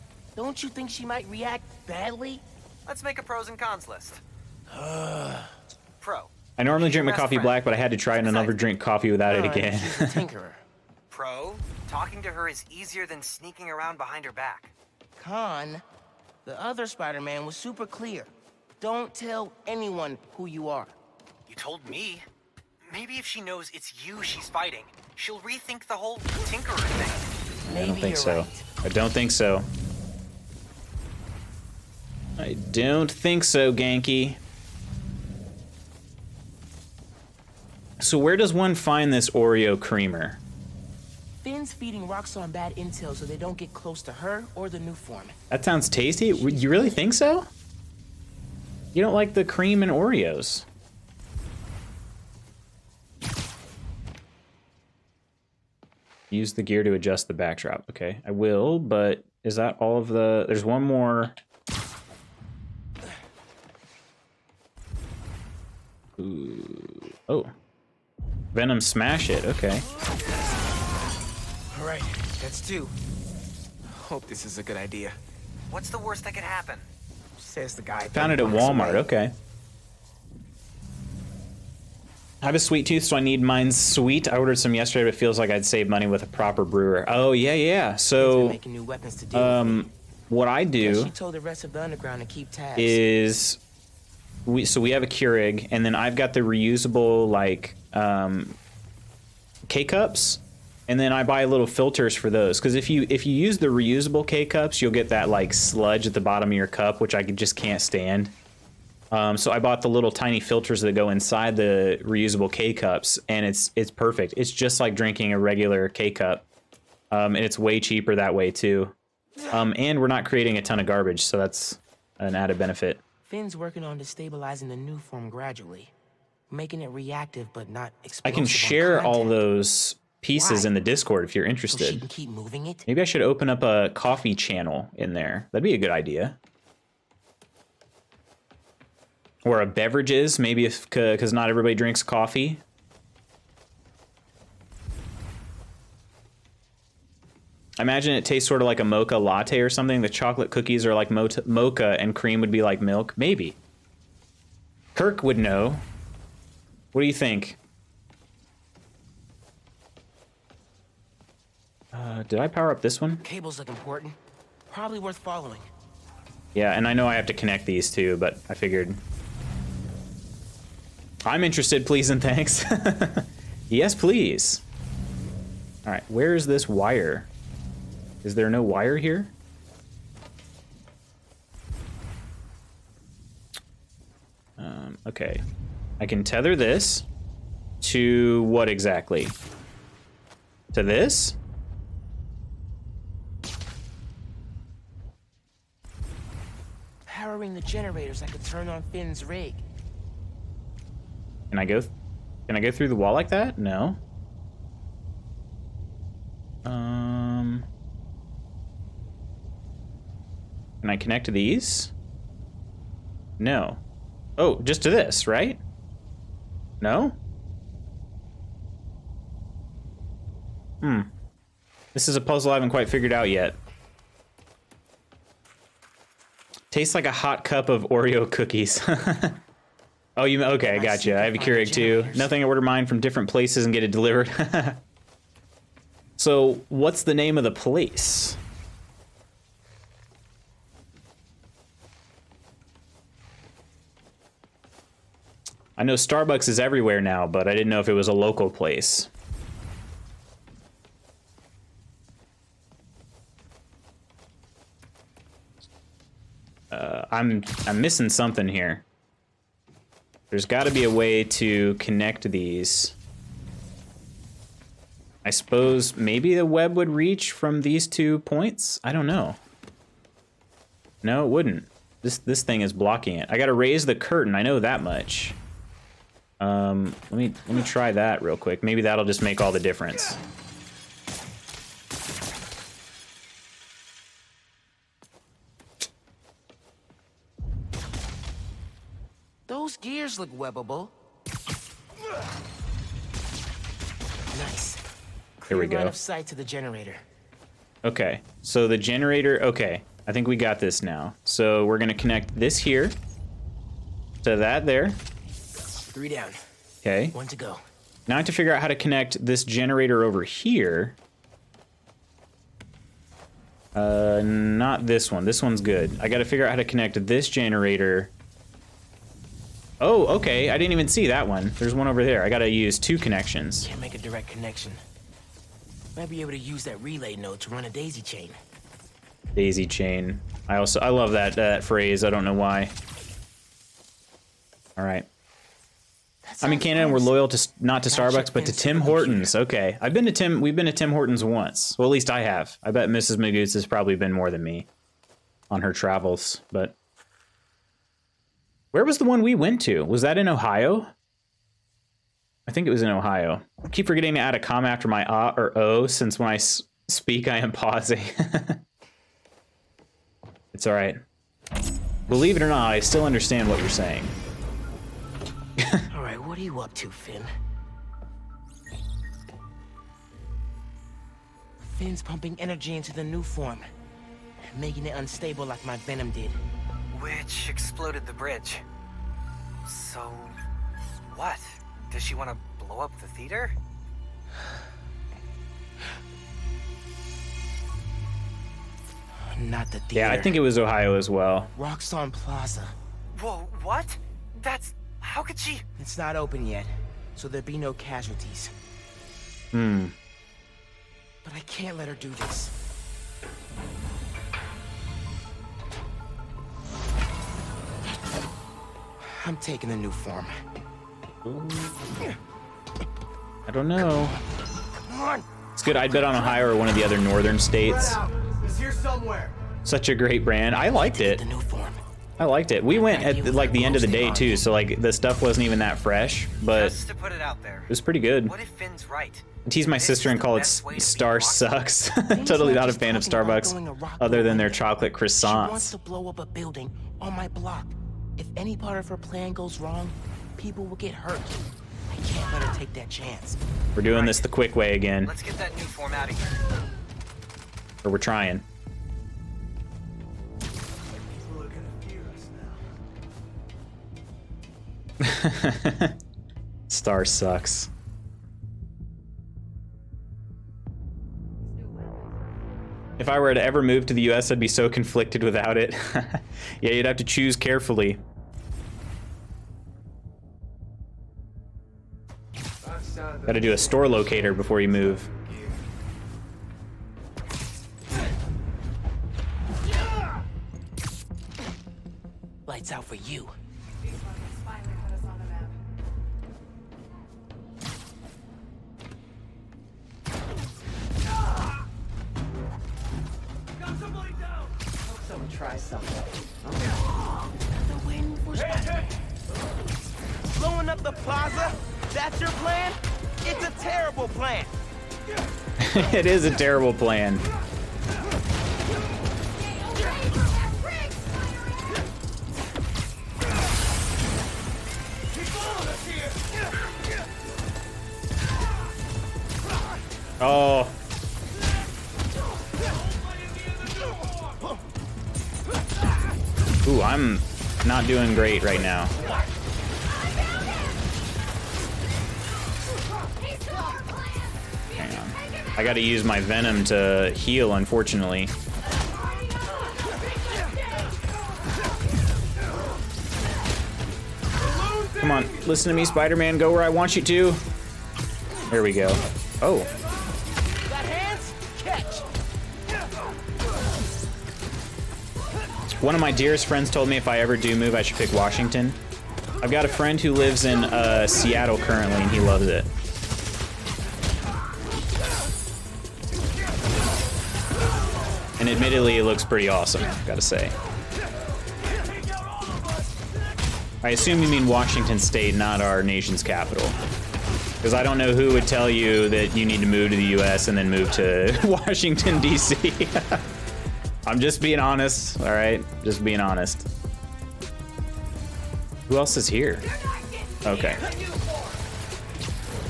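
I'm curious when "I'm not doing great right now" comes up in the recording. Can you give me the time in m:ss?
8:46.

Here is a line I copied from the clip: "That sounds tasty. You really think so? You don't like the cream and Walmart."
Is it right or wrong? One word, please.
wrong.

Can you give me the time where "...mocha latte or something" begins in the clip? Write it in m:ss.
2:28.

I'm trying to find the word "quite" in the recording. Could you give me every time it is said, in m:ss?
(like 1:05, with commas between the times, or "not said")
3:42.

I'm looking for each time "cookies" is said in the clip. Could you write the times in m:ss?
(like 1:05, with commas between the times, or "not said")
2:30, 3:48.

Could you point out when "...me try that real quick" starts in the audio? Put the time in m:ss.
4:37.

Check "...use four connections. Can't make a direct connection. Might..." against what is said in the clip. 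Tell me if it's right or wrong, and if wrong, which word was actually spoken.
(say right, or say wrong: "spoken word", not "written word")
wrong: "two", not "four".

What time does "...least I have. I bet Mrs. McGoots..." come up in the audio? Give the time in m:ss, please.
5:41.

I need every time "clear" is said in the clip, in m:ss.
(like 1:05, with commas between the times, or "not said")
0:17, 4:55.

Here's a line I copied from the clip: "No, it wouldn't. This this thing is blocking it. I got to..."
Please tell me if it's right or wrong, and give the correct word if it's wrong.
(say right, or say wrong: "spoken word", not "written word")
right.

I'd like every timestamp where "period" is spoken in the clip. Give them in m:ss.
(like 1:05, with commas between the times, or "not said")
not said.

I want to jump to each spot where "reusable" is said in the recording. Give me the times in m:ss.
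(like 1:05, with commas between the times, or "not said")
1:36, 1:43, 1:52.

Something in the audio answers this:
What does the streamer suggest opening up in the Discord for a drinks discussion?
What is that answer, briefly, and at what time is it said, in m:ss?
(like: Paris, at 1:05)
A coffee channel, at 2:13.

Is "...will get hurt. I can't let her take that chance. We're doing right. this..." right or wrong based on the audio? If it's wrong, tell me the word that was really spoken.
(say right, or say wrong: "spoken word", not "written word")
right.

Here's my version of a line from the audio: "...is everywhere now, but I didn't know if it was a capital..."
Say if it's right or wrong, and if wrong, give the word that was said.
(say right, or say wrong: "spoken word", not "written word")
wrong: "local", not "capital".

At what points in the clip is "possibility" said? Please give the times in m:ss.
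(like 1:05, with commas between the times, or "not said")
not said.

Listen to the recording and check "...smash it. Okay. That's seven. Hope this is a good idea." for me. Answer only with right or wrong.
wrong.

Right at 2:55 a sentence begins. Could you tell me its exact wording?
All right, where is this wire?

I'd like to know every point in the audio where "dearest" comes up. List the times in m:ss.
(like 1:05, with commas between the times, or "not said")
9:16.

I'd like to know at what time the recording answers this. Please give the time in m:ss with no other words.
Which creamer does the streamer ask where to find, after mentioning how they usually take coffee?
0:39.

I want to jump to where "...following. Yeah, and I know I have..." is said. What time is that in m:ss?
2:45.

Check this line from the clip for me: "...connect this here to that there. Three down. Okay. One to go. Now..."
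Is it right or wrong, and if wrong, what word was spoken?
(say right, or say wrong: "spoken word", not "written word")
right.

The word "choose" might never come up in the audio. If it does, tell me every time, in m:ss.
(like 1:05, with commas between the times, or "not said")
7:47.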